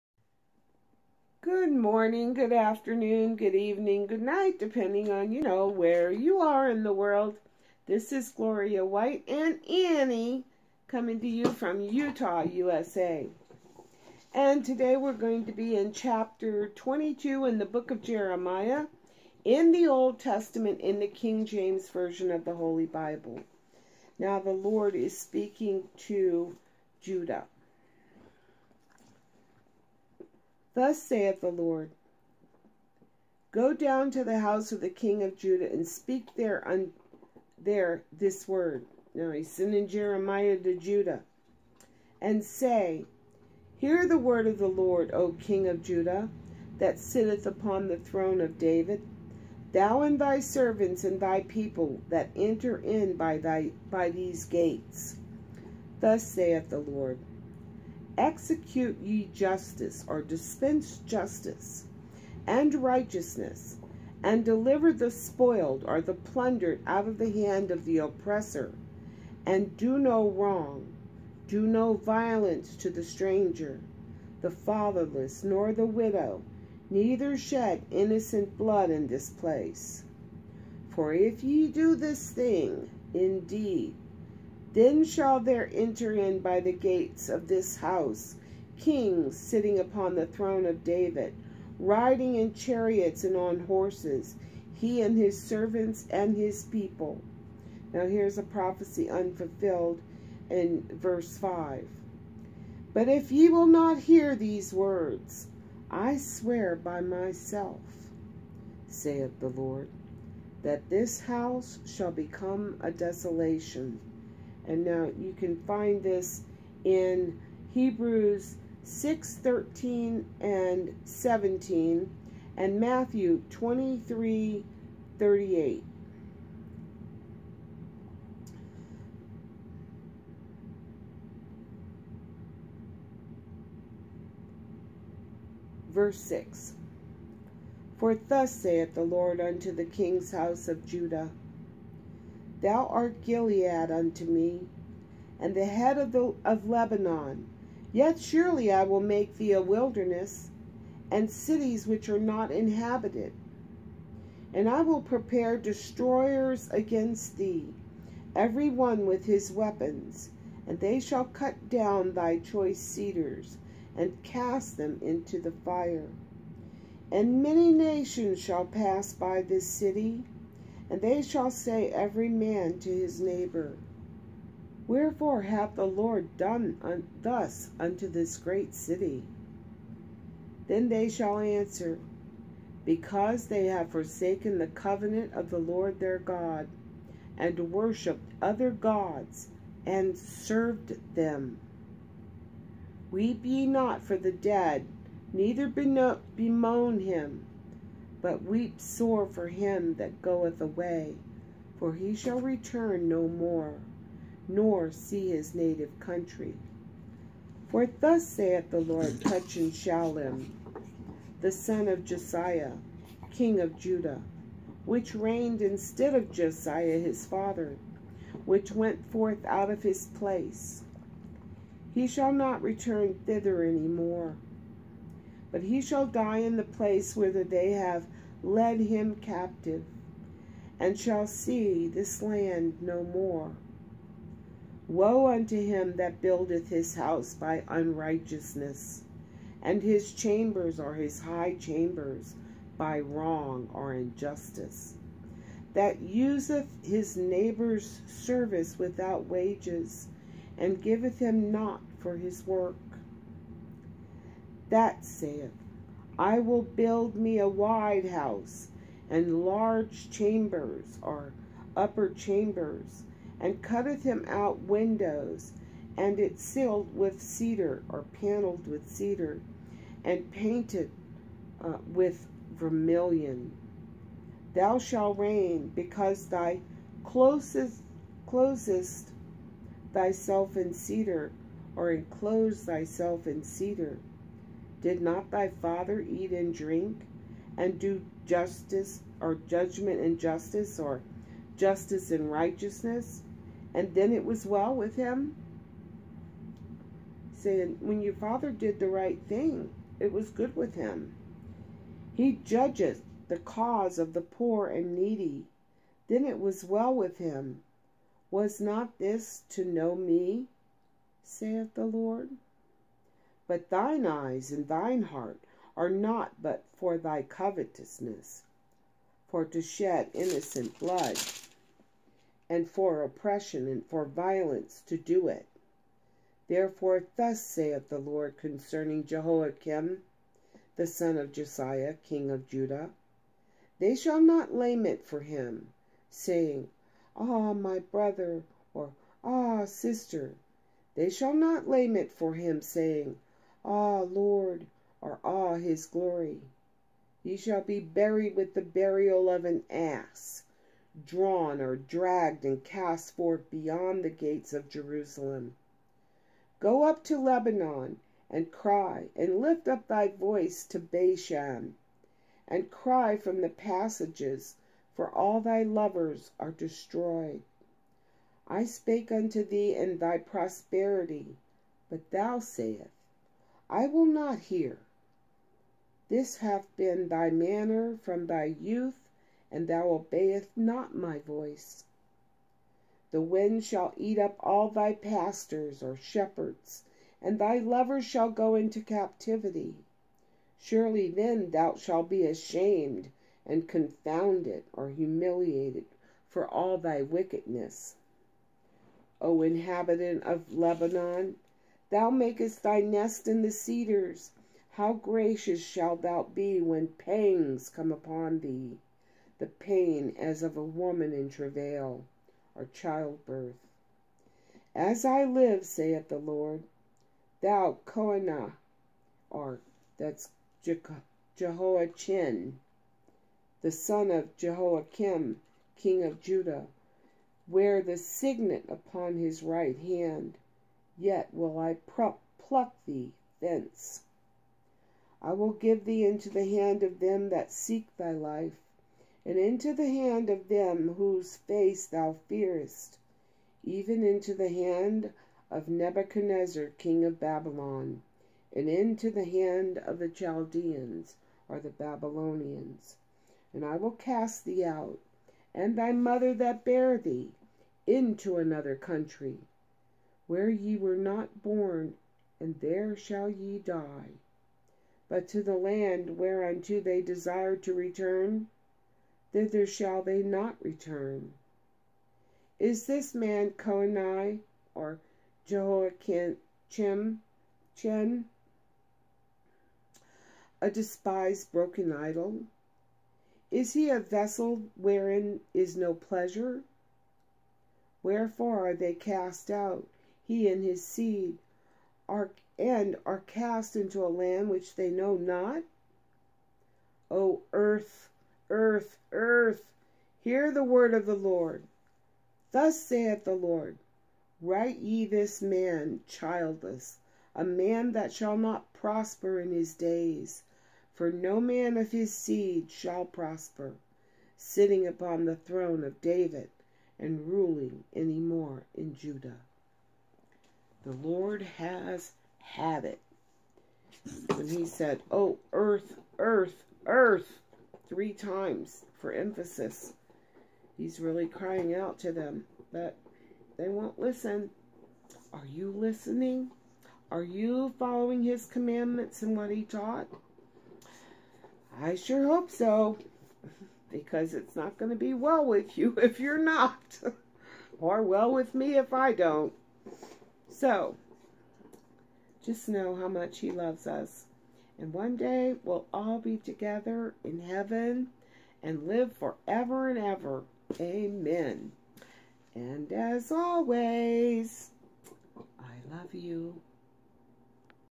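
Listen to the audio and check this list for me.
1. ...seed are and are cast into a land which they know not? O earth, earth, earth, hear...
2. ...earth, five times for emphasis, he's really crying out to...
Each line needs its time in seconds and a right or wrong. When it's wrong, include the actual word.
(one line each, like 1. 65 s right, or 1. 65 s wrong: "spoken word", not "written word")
1. 490 s right
2. 526 s wrong: "three", not "five".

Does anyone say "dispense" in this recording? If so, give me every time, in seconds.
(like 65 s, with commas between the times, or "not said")
60 s.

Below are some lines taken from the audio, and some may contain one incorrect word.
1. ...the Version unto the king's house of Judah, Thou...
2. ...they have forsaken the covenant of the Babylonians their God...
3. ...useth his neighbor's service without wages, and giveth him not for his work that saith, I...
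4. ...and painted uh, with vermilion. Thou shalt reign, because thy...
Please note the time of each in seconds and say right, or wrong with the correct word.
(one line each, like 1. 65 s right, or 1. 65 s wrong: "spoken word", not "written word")
1. 138 s wrong: "Lord", not "Version"
2. 183 s wrong: "Lord", not "Babylonians"
3. 246 s right
4. 270 s right.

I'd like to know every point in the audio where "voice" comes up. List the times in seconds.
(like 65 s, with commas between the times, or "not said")
360 s, 381 s.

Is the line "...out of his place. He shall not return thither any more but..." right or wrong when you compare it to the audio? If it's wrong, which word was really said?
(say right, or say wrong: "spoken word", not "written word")
right.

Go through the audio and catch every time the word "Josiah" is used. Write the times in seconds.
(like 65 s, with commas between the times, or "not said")
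212 s, 216 s, 331 s.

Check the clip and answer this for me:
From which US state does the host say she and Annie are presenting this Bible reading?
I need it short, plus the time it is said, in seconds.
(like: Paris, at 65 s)
Utah, at 11 s.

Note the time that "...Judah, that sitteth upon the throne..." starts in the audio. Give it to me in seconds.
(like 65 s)
45 s.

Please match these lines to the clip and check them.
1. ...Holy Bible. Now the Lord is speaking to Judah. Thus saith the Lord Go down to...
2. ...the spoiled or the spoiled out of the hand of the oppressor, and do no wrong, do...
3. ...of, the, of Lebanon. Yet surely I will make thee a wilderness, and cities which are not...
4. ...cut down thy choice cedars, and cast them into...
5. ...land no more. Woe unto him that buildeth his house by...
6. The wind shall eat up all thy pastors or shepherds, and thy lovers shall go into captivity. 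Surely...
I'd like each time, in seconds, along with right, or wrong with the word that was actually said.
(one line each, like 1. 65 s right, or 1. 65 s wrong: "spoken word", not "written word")
1. 22 s right
2. 64 s wrong: "plundered", not "spoiled"
3. 145 s right
4. 161 s right
5. 232 s right
6. 383 s right.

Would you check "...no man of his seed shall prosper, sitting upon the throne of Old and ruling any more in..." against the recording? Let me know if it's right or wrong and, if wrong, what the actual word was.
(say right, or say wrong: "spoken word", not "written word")
wrong: "David", not "Old".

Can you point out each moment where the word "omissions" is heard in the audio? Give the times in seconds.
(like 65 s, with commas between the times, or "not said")
not said.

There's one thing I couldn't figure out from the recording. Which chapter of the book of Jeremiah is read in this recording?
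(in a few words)
Chapter 22.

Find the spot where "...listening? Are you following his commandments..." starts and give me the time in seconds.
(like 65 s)
535 s.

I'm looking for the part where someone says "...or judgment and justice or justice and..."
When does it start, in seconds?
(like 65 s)
289 s.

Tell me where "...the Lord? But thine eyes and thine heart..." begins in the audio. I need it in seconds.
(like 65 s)
311 s.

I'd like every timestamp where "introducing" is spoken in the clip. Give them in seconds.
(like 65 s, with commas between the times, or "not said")
not said.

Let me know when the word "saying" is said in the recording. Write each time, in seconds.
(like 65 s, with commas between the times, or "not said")
297 s, 336 s, 342 s.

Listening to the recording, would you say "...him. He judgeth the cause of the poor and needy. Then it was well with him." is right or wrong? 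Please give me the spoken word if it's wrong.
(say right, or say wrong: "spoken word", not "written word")
right.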